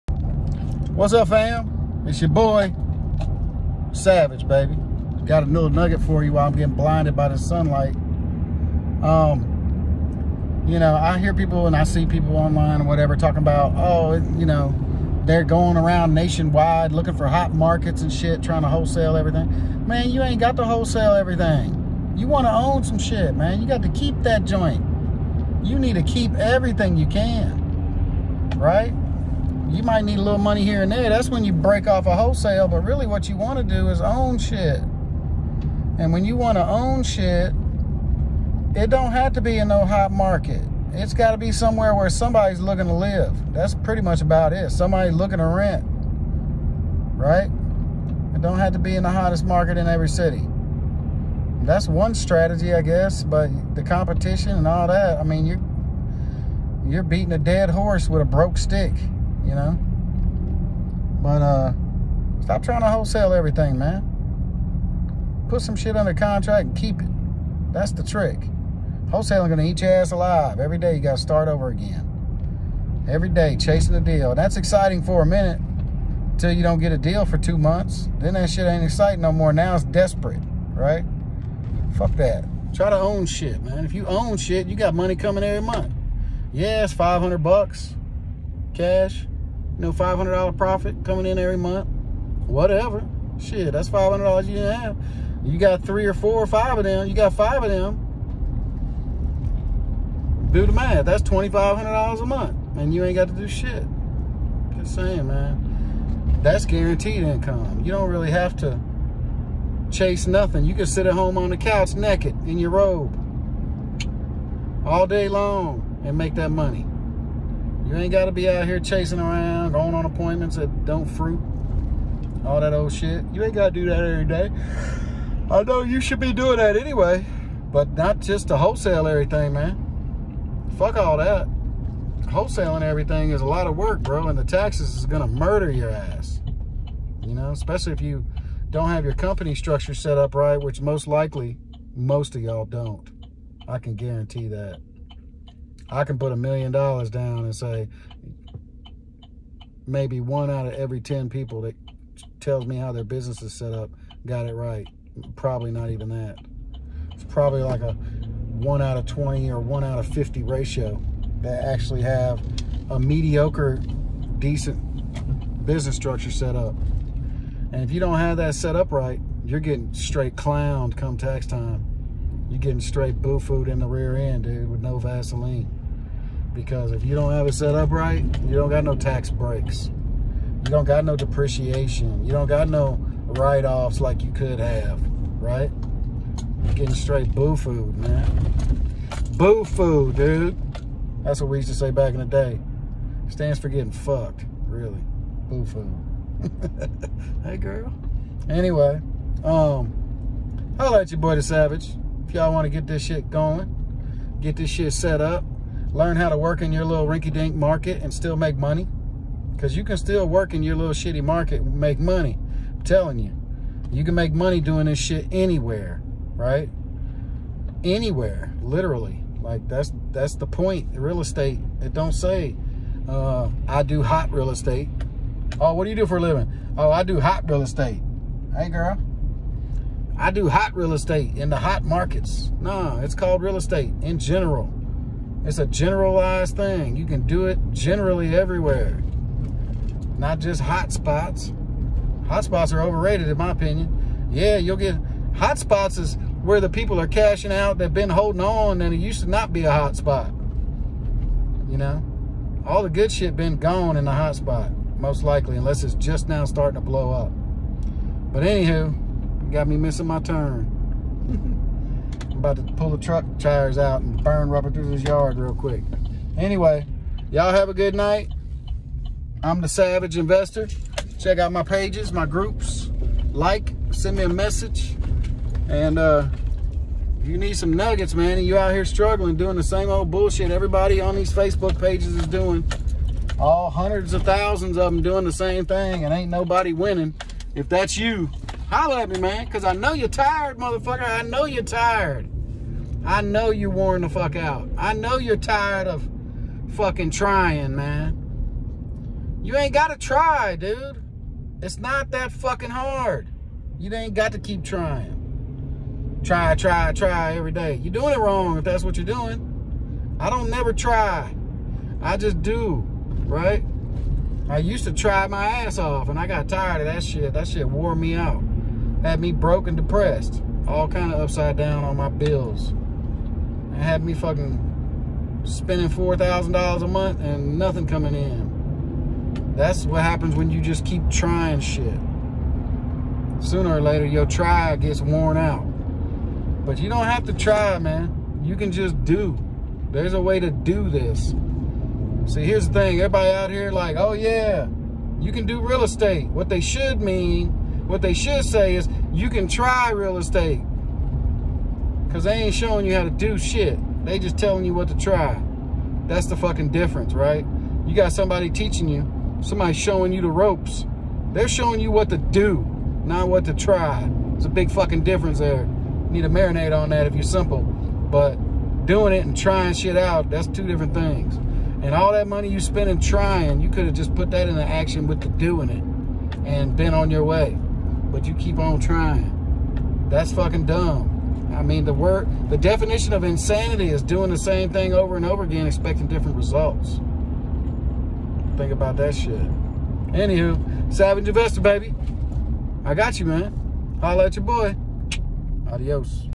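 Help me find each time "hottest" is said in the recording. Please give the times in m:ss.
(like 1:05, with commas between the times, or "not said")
0:49.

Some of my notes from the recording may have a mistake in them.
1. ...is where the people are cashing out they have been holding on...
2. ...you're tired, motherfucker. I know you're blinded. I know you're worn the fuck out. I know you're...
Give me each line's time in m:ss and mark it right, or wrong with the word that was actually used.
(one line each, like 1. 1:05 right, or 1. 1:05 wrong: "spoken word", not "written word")
1. 4:05 right
2. 4:49 wrong: "tired", not "blinded".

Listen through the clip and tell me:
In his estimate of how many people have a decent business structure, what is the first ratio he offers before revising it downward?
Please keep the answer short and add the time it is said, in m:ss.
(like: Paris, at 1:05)
1 out of 10, at 2:30.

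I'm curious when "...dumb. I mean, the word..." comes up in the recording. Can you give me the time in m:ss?
6:20.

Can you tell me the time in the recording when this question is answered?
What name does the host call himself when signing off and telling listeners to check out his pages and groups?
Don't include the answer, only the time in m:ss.
4:29.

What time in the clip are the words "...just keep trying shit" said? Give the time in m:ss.
5:30.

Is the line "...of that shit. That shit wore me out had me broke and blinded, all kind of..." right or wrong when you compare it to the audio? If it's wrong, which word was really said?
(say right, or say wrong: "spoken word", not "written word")
wrong: "depressed", not "blinded".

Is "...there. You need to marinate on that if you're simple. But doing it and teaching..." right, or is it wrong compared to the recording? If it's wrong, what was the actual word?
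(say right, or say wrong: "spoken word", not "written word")
wrong: "trying", not "teaching".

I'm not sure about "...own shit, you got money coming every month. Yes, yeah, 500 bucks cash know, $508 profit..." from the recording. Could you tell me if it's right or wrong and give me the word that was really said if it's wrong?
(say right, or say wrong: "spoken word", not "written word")
wrong: "500", not "508".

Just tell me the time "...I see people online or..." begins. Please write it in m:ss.
0:11.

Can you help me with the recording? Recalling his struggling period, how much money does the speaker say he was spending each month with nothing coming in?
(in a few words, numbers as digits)
$4,000.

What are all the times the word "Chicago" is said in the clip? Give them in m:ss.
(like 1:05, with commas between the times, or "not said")
not said.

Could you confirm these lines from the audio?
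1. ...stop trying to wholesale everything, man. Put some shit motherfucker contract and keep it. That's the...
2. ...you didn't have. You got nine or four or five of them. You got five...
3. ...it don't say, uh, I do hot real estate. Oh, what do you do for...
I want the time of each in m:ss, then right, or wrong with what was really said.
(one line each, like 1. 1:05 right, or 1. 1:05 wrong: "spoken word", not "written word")
1. 1:02 wrong: "under", not "motherfucker"
2. 1:34 wrong: "three", not "nine"
3. 3:41 right.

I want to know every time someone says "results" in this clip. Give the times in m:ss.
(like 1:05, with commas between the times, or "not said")
6:26.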